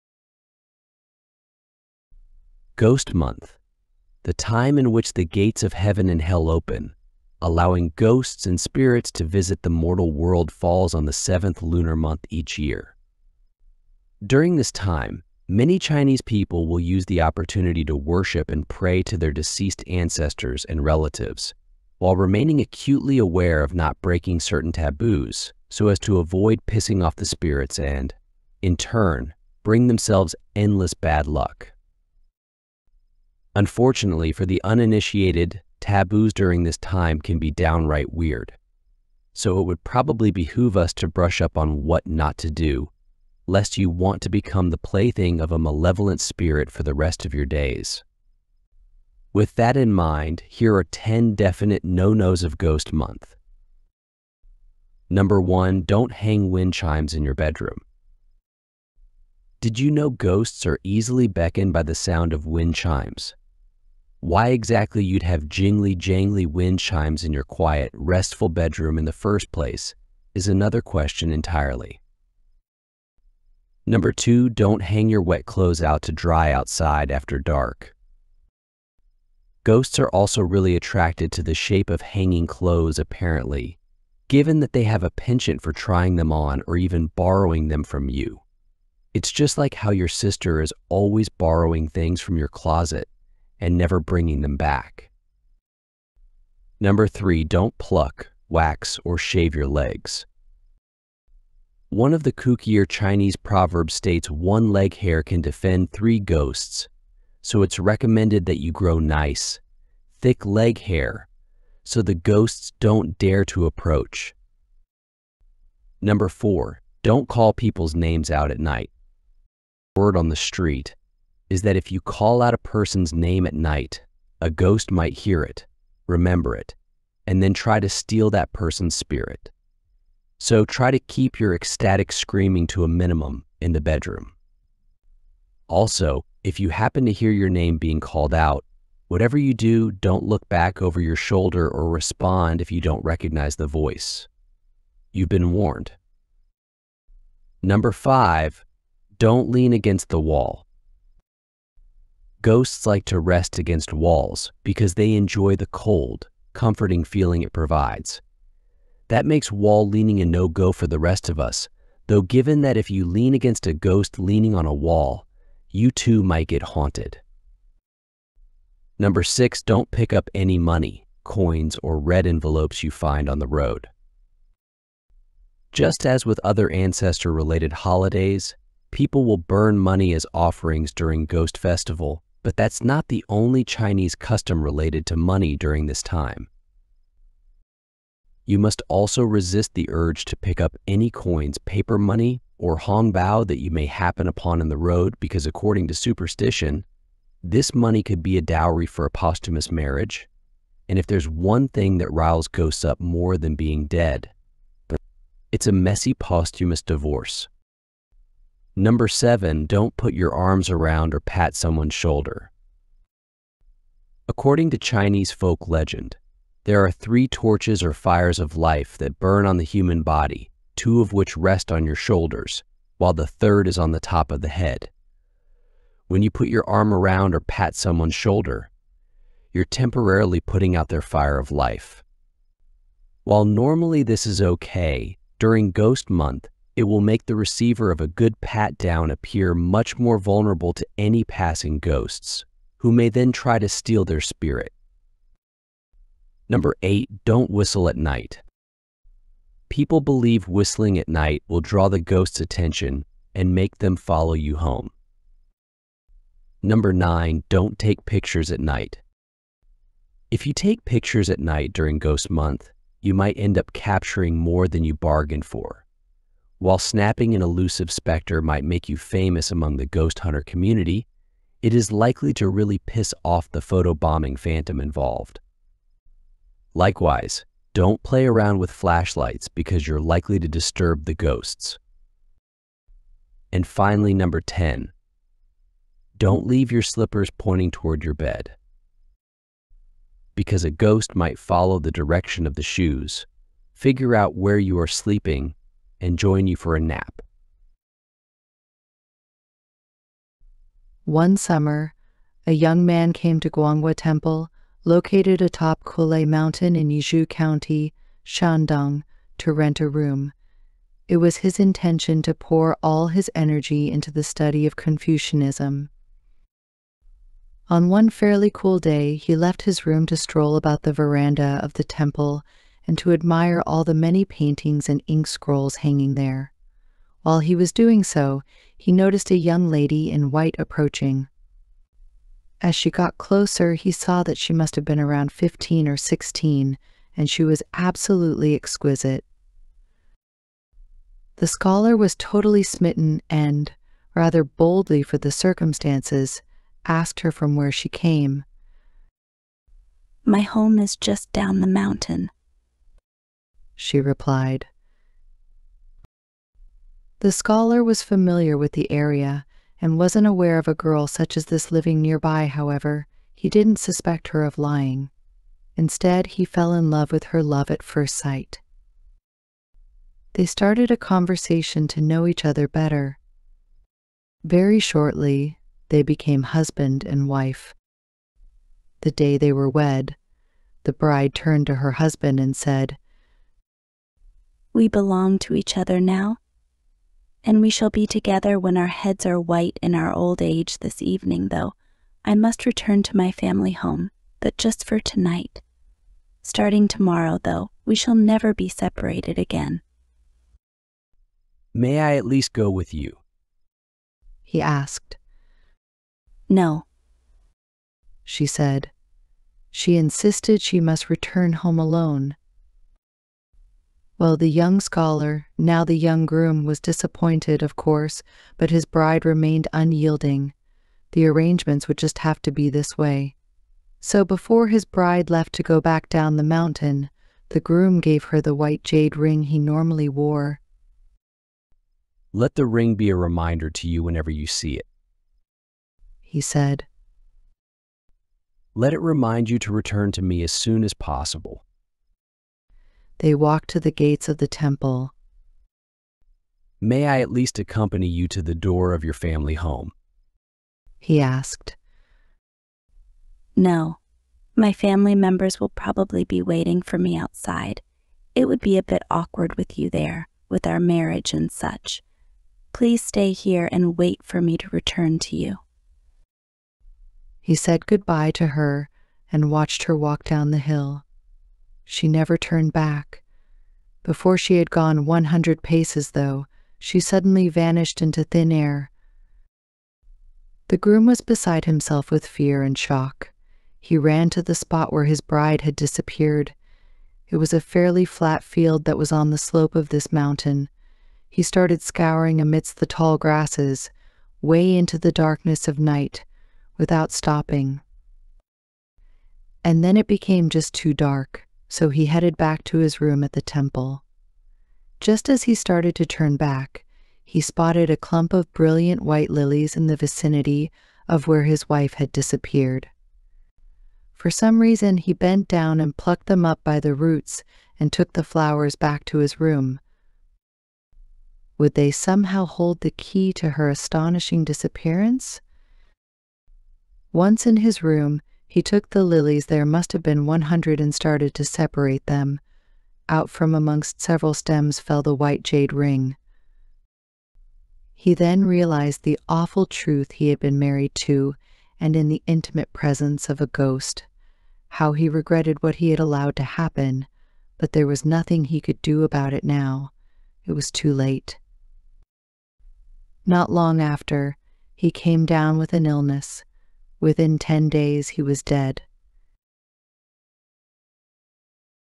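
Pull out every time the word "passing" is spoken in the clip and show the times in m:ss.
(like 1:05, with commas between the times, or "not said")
4:01.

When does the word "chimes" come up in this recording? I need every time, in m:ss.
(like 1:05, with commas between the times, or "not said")
0:56, 1:02, 1:06.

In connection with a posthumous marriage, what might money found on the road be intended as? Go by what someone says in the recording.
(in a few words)
A dowry.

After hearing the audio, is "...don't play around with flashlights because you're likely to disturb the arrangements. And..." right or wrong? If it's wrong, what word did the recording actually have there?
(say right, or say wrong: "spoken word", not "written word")
wrong: "ghosts", not "arrangements".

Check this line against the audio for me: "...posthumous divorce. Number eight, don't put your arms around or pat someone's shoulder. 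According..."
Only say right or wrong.
wrong.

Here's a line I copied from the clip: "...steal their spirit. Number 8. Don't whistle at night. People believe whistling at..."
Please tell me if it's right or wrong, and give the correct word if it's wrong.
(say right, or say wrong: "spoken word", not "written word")
right.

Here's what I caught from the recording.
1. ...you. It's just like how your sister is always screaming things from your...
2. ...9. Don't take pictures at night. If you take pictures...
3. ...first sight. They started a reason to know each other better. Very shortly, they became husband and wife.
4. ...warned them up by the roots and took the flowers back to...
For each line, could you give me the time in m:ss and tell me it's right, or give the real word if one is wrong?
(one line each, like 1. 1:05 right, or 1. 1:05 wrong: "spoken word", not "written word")
1. 1:28 wrong: "borrowing", not "screaming"
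2. 4:16 right
3. 6:07 wrong: "conversation", not "reason"
4. 8:35 wrong: "plucked", not "warned".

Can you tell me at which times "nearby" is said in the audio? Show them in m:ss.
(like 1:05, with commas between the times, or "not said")
6:01.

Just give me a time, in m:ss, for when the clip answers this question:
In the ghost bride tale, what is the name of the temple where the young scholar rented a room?
5:03.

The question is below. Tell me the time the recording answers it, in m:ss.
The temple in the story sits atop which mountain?
5:05.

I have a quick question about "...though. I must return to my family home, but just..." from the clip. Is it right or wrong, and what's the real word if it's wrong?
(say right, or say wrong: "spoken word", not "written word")
right.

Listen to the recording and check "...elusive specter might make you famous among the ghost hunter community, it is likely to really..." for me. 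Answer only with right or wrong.
right.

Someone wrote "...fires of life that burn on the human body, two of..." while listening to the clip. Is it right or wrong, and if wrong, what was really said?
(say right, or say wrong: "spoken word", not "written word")
right.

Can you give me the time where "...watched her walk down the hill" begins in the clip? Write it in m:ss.
7:49.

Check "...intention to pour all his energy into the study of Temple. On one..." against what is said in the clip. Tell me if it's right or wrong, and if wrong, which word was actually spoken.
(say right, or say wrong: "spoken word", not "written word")
wrong: "Confucianism", not "Temple".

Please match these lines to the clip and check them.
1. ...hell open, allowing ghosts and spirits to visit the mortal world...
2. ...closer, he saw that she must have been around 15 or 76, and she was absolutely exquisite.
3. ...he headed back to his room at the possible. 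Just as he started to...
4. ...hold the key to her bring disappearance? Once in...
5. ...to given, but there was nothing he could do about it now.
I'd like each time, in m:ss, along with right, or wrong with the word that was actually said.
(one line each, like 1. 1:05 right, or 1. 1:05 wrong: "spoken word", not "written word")
1. 0:06 right
2. 5:33 wrong: "16", not "76"
3. 8:21 wrong: "temple", not "possible"
4. 8:42 wrong: "astonishing", not "bring"
5. 9:06 wrong: "happen", not "given".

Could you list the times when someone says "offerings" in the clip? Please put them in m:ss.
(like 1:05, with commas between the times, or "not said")
3:00.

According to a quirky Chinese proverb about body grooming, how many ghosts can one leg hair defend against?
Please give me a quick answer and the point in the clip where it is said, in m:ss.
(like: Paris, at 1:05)
3, at 1:45.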